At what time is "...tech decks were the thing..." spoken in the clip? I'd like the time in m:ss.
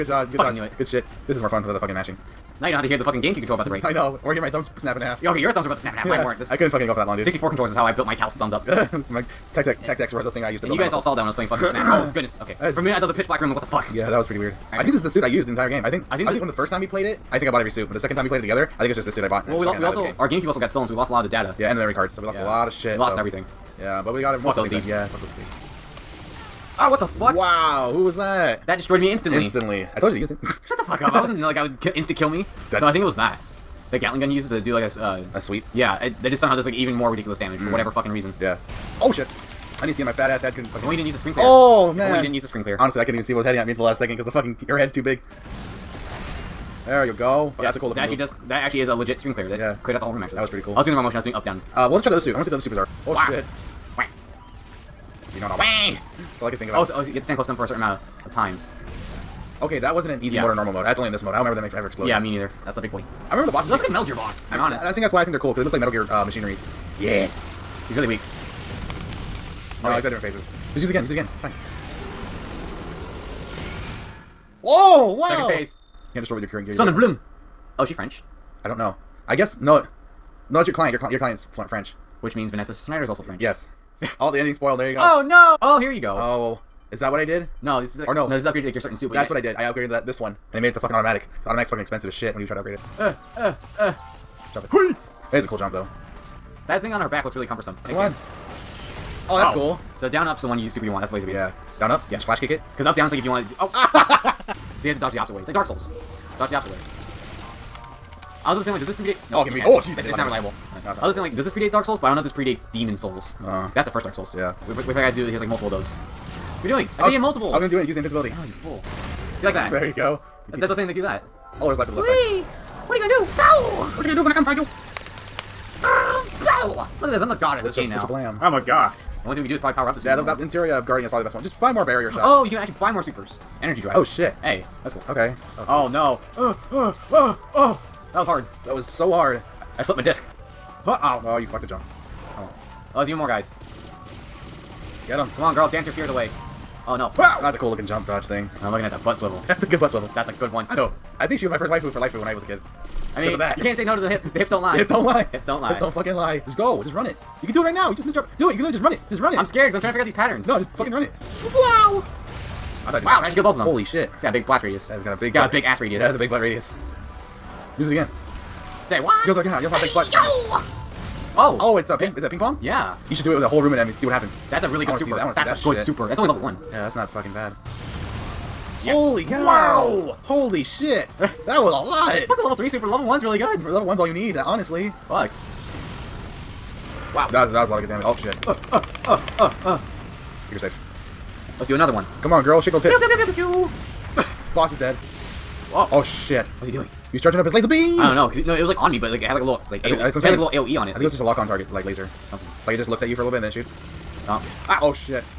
0:09.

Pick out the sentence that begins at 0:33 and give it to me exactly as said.
The Gatling gun he uses to do like a uh, a sweep.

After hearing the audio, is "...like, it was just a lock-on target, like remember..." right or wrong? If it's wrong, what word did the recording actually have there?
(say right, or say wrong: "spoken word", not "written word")
wrong: "laser", not "remember".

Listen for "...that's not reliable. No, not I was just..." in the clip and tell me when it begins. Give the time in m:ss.
1:49.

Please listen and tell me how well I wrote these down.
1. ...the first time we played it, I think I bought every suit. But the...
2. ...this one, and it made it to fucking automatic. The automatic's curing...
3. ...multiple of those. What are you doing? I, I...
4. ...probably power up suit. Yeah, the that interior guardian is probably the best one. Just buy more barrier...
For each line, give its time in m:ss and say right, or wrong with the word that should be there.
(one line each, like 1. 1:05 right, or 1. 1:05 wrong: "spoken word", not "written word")
1. 0:16 right
2. 1:30 wrong: "fucking", not "curing"
3. 1:55 right
4. 2:09 right.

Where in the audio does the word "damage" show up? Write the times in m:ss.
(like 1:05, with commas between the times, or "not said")
0:37, 3:07.